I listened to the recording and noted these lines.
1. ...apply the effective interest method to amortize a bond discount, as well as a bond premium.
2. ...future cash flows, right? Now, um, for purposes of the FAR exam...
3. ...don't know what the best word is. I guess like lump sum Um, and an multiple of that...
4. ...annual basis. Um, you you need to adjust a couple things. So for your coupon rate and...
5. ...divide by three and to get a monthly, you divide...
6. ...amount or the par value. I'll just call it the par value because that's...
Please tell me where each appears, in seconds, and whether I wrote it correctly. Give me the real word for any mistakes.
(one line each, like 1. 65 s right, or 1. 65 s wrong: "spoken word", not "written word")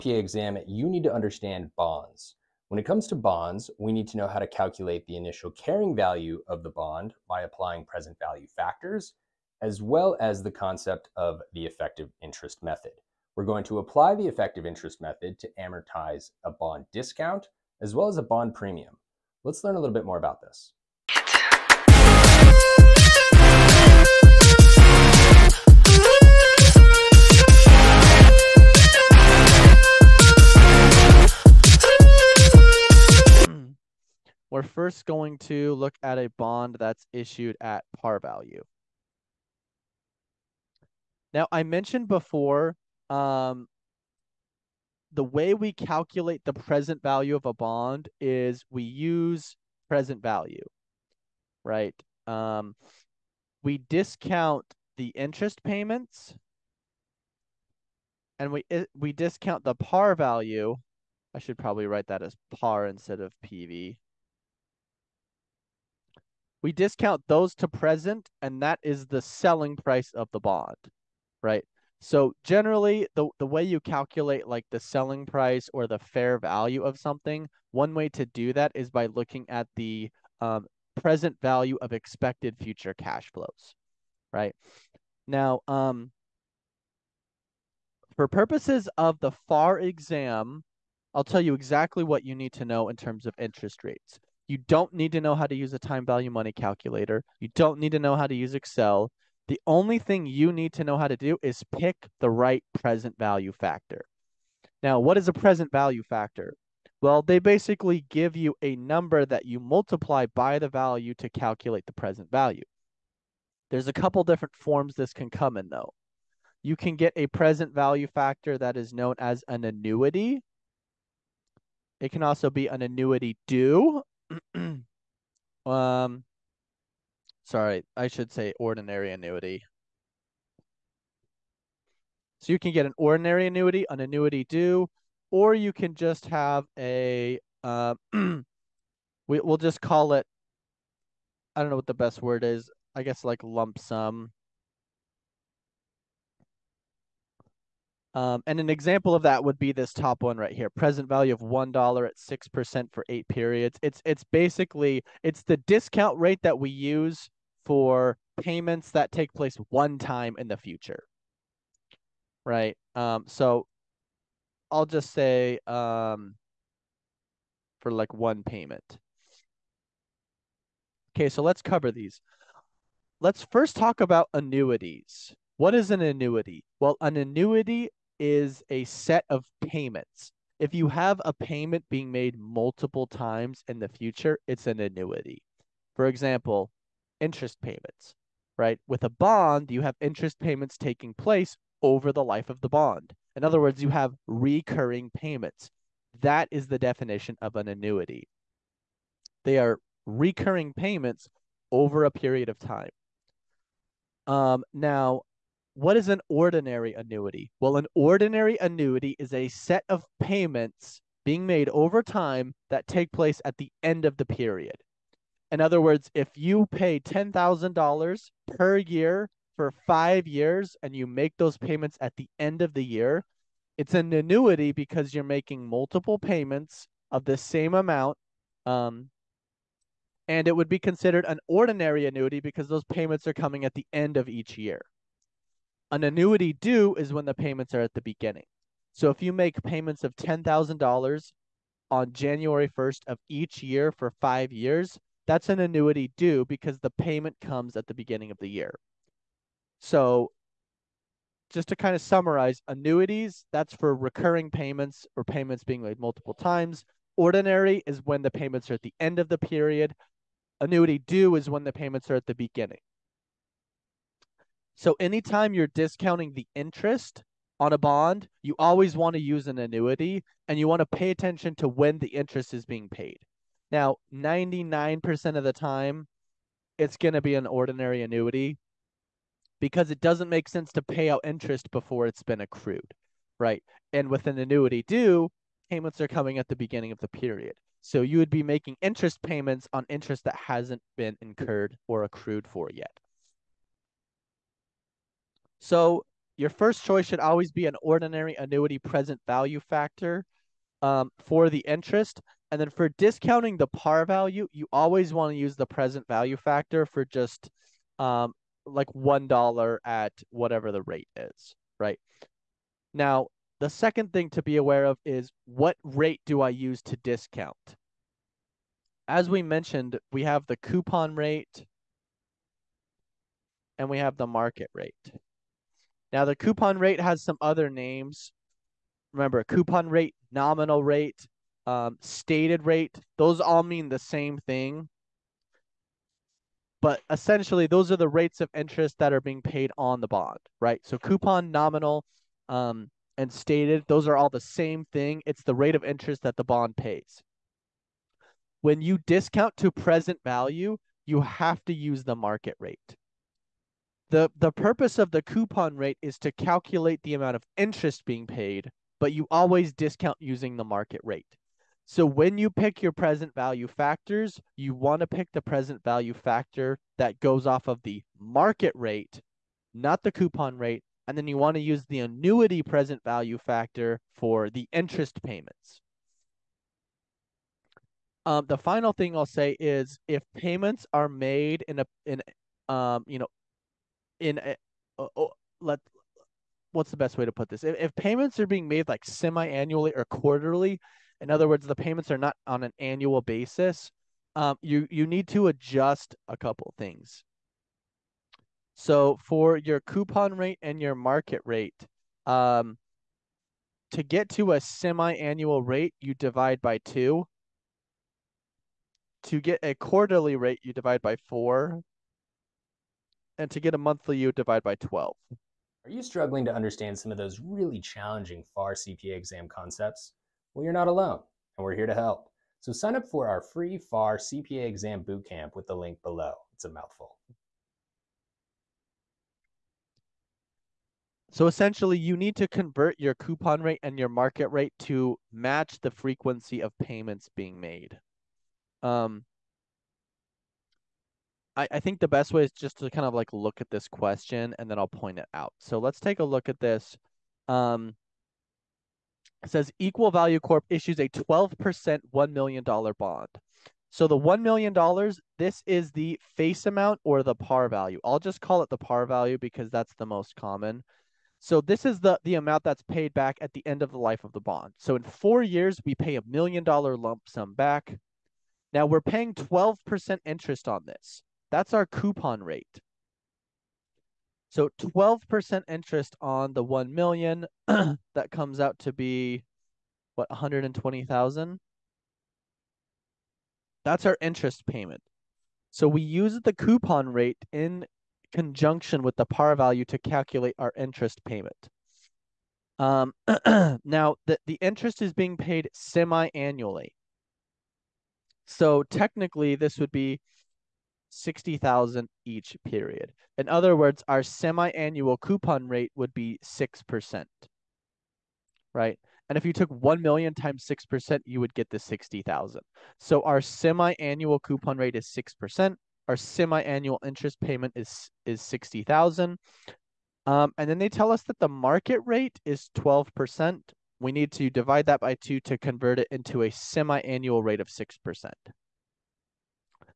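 1. 13 s right
2. 82 s right
3. 141 s wrong: "example", not "multiple"
4. 392 s right
5. 410 s wrong: "four", not "three"
6. 456 s right.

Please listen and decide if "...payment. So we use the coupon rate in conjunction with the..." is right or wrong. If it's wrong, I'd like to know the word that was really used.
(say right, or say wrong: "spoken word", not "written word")
right.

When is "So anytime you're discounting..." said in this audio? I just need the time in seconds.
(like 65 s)
264 s.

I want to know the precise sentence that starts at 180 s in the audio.
If you have a payment being made multiple times in the future, it's an annuity.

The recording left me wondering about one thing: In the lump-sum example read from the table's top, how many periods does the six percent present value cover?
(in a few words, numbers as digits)
8.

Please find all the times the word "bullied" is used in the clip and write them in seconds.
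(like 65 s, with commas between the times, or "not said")
not said.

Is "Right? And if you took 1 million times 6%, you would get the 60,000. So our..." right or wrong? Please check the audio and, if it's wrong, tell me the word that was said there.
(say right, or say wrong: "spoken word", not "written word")
right.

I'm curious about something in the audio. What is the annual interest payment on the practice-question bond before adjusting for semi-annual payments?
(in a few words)
120,000.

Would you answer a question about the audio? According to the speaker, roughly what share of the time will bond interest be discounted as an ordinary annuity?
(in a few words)
99%.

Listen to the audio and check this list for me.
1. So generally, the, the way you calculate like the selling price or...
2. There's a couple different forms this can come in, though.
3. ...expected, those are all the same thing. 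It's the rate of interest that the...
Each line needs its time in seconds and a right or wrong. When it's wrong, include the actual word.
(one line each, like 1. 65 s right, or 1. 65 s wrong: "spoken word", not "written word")
1. 72 s right
2. 113 s right
3. 343 s wrong: "stated", not "expected".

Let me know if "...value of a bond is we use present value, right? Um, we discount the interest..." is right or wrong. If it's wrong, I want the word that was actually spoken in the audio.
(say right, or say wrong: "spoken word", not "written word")
right.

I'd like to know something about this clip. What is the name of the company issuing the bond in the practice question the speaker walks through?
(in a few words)
Equal Value Corp.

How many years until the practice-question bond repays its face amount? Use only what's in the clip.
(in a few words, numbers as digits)
4.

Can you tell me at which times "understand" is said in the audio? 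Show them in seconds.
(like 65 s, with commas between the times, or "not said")
1 s, 416 s.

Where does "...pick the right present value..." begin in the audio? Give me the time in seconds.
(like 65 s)
101 s.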